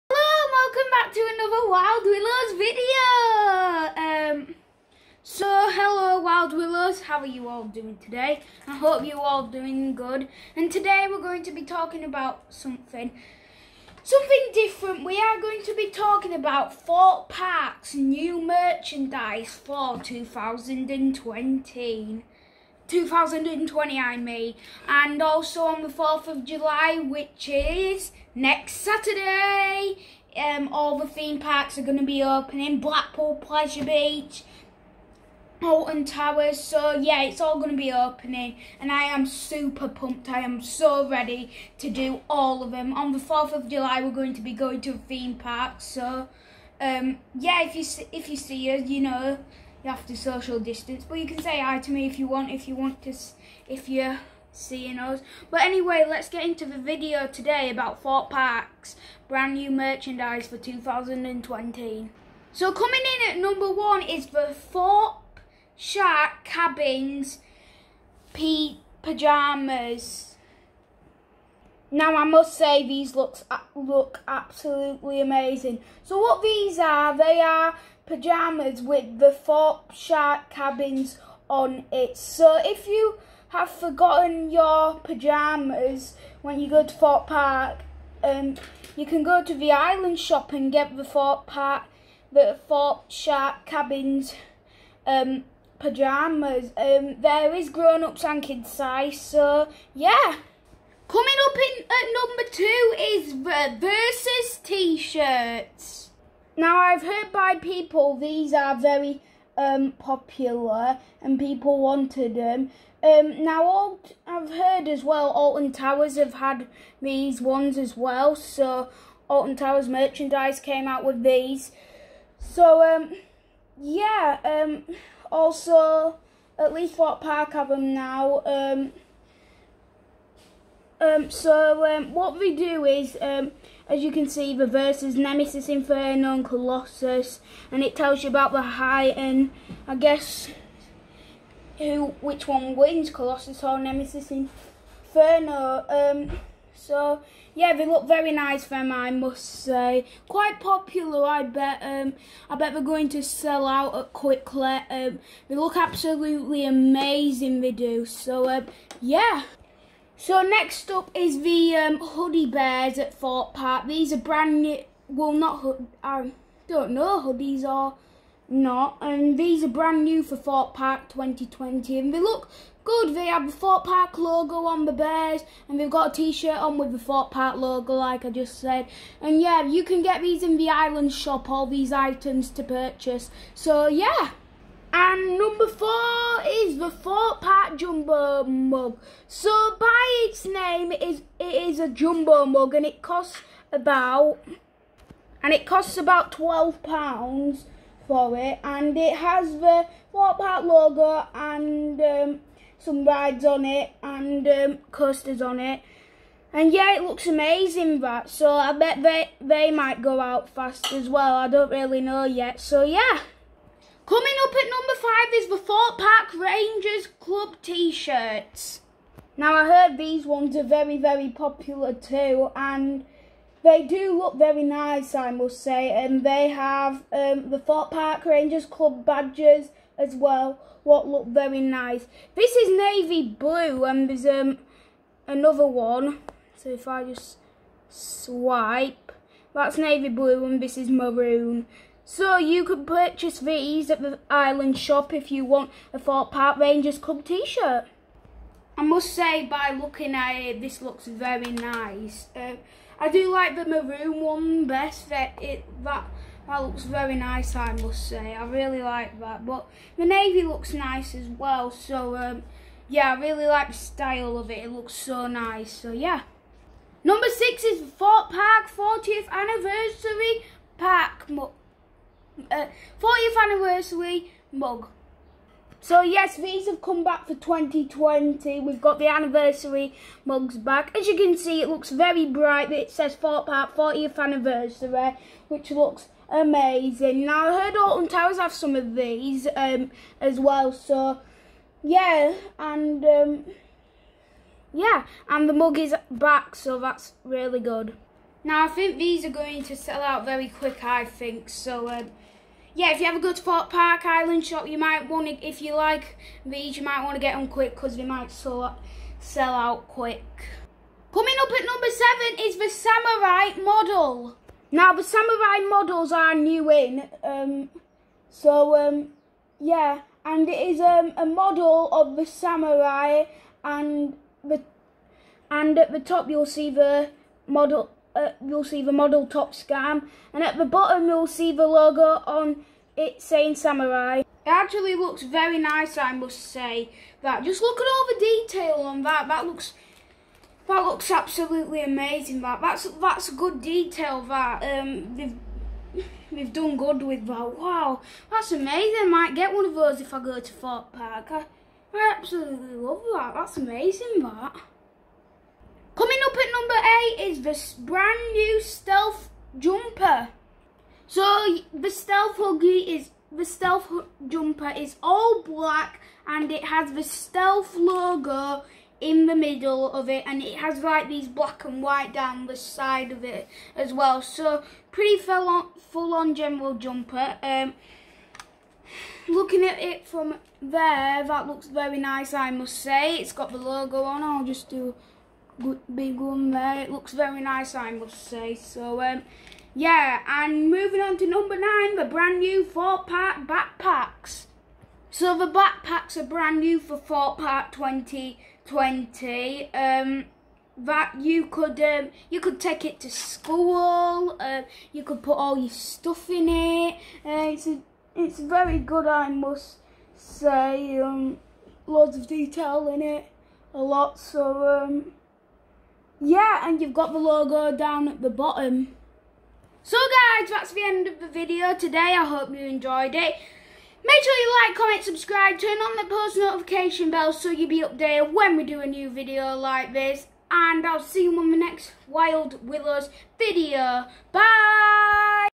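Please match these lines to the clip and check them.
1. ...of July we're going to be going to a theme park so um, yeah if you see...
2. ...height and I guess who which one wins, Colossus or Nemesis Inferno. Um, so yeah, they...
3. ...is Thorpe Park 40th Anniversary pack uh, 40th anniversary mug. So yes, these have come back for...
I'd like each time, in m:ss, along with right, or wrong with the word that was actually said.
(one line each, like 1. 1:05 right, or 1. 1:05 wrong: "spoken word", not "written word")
1. 0:43 right
2. 2:18 right
3. 4:27 right.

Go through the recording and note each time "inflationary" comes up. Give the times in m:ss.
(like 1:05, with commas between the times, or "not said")
not said.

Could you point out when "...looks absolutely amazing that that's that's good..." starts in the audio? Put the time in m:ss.
5:40.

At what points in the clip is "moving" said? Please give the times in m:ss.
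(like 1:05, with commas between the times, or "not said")
6:30.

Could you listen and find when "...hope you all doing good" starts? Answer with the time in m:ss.
0:08.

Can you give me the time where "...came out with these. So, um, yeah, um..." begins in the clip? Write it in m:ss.
2:00.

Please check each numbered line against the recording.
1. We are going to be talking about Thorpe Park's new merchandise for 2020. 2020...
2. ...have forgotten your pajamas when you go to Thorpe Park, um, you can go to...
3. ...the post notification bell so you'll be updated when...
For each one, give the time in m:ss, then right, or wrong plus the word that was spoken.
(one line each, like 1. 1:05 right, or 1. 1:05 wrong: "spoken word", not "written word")
1. 0:15 right
2. 1:23 right
3. 7:05 right.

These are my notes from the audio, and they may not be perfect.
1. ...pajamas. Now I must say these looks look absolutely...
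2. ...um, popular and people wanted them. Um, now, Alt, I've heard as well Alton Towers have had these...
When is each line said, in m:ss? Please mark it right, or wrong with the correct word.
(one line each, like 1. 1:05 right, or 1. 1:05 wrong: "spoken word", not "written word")
1. 1:09 right
2. 1:49 right.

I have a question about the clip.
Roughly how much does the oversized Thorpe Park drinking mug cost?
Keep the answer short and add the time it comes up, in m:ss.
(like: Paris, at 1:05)
£12, at 3:16.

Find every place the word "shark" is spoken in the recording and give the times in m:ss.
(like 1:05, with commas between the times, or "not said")
1:05, 1:19, 1:33.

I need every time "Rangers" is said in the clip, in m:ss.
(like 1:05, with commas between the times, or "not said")
3:36, 3:48, 4:06.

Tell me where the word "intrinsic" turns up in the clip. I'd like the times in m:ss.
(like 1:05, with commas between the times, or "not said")
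not said.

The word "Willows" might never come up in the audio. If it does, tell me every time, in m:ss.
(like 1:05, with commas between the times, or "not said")
0:02, 0:06, 7:12.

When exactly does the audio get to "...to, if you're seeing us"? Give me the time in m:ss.
0:53.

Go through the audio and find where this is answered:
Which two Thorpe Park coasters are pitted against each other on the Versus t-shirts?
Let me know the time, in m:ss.
2:15.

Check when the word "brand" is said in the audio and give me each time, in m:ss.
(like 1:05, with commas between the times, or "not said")
0:59, 2:44, 2:49, 5:57, 6:32, 6:36.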